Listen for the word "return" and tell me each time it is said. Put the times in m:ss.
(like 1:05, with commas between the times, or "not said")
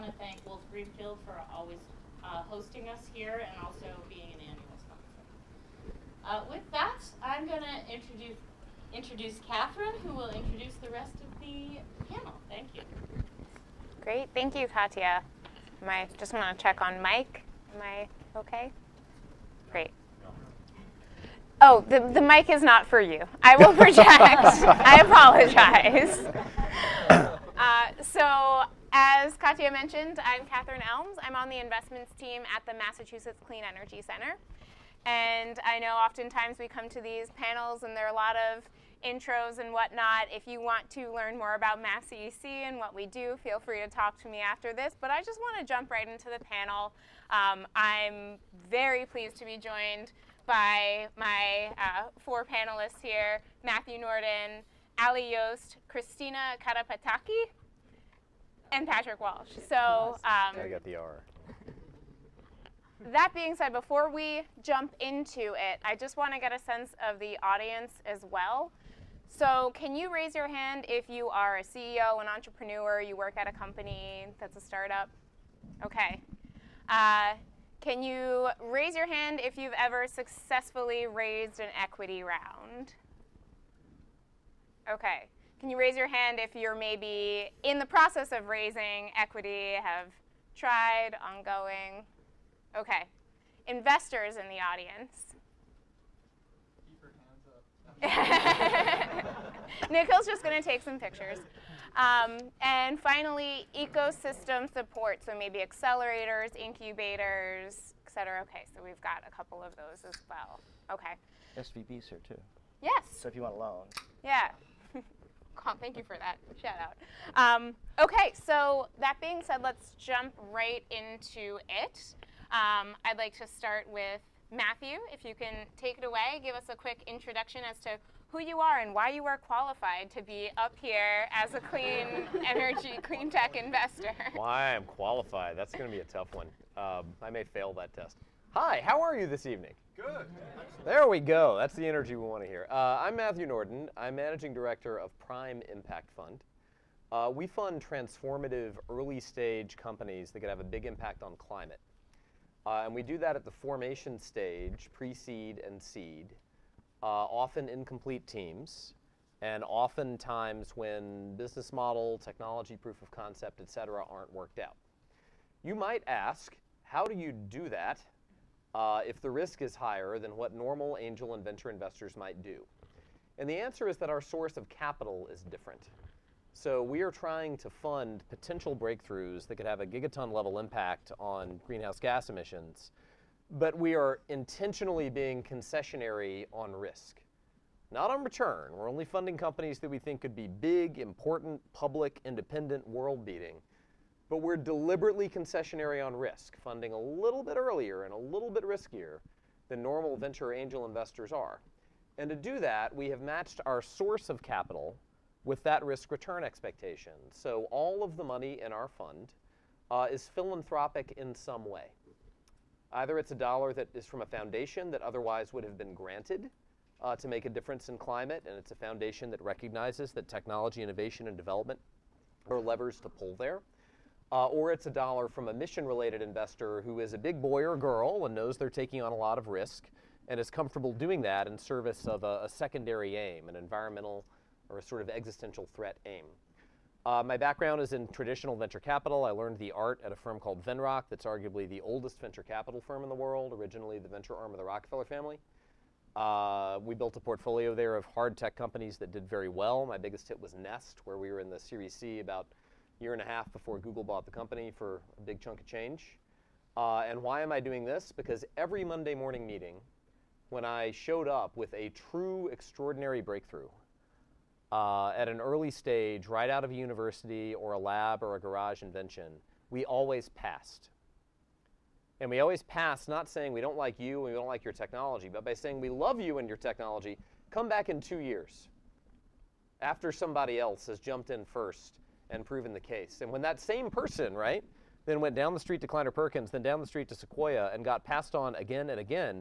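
3:08, 3:26.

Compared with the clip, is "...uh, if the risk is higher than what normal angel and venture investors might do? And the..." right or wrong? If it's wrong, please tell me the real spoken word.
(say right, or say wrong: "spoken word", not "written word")
right.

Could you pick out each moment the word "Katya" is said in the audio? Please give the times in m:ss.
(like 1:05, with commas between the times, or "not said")
0:14, 0:29.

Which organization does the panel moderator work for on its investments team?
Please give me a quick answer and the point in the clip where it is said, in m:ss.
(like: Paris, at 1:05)
Massachusetts Clean Energy Center, at 0:32.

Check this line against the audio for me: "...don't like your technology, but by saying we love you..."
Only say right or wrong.
right.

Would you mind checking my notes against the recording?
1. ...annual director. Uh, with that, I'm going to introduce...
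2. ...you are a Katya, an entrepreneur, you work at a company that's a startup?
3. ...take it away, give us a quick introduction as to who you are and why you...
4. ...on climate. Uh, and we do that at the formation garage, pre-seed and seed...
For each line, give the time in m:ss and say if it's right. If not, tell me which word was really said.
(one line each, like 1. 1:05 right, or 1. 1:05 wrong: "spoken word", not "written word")
1. 0:04 wrong: "sponsor", not "director"
2. 1:11 wrong: "CEO", not "Katya"
3. 2:05 right
4. 2:31 wrong: "stage", not "garage".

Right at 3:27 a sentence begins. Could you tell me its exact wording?
So all of the money in our fund uh, is philanthropic in some way.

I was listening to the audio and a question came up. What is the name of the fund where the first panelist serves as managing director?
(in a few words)
Prime Impact Fund.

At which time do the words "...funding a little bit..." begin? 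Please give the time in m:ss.
3:16.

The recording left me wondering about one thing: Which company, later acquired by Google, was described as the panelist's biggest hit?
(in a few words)
Nest.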